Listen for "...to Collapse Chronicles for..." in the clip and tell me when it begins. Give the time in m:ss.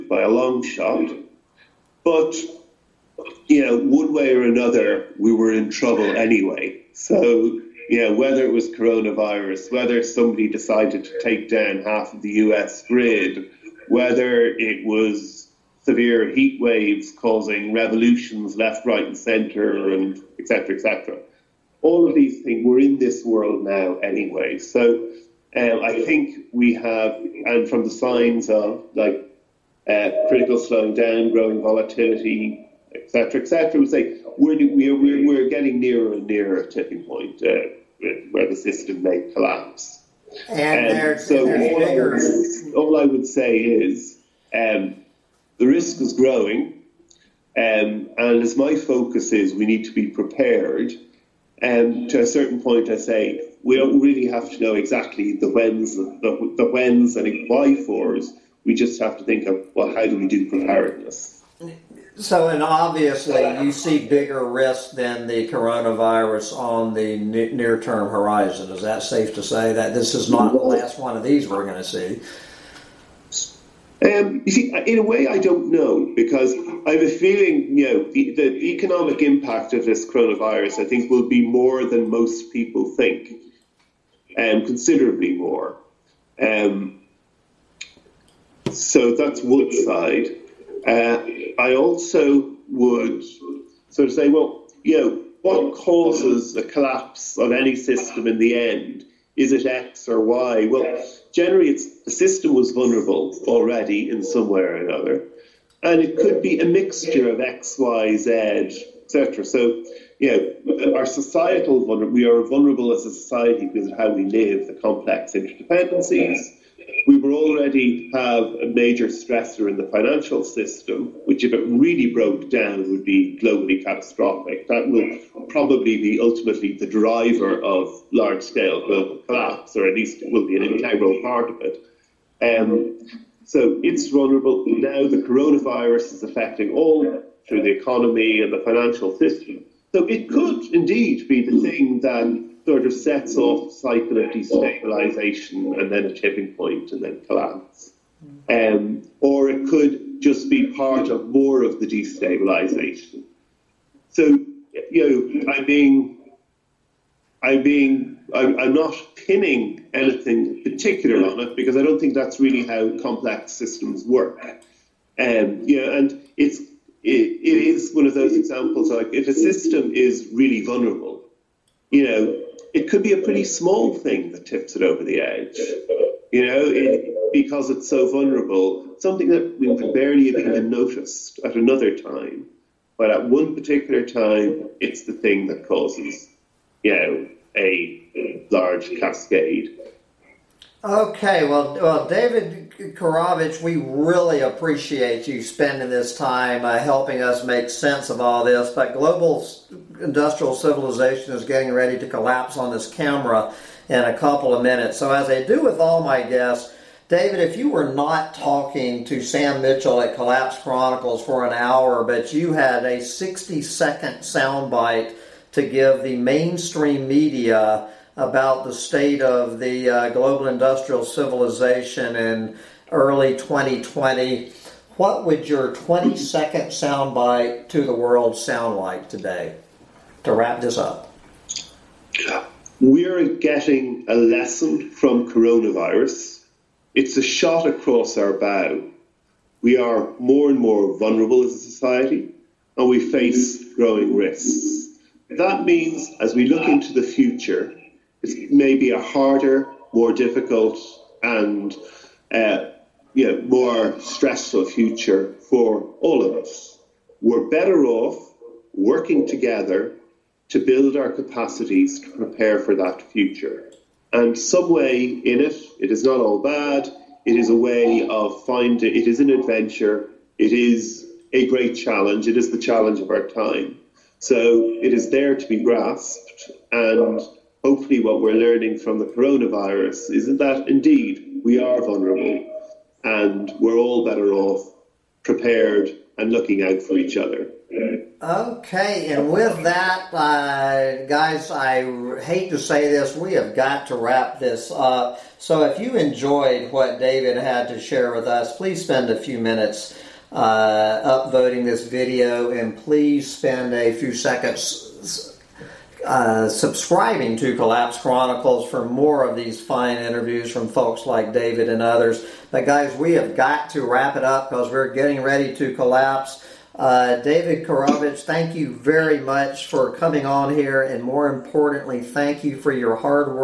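5:07.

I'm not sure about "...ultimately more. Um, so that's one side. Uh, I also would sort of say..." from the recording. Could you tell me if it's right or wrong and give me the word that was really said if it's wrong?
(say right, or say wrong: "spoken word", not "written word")
wrong: "considerably", not "ultimately".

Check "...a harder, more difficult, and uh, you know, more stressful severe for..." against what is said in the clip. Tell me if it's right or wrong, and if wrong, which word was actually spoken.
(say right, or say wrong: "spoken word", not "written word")
wrong: "future", not "severe".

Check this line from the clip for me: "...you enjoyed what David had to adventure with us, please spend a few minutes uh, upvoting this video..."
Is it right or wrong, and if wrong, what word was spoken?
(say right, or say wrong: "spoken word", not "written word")
wrong: "share", not "adventure".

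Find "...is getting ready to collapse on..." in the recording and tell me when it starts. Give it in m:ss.
3:21.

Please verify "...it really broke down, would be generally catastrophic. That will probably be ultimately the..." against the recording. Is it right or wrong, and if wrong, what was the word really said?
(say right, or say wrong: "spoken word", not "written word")
wrong: "globally", not "generally".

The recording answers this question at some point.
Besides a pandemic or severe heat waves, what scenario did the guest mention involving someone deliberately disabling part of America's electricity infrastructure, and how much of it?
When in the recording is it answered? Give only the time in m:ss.
0:11.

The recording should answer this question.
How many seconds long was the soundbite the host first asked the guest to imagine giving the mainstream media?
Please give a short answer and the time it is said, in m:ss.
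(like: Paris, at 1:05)
60, at 3:32.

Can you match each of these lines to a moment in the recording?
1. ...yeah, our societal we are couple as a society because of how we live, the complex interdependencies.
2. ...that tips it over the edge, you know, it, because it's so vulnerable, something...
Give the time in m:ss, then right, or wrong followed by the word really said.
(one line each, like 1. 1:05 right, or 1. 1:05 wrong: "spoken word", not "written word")
1. 1:50 wrong: "vulnerable", not "couple"
2. 2:54 right.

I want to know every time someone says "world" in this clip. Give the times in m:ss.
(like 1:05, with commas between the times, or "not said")
0:23, 3:47.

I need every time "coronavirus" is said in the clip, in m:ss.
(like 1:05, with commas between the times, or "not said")
0:08, 1:05, 1:20, 2:15, 3:55, 4:39.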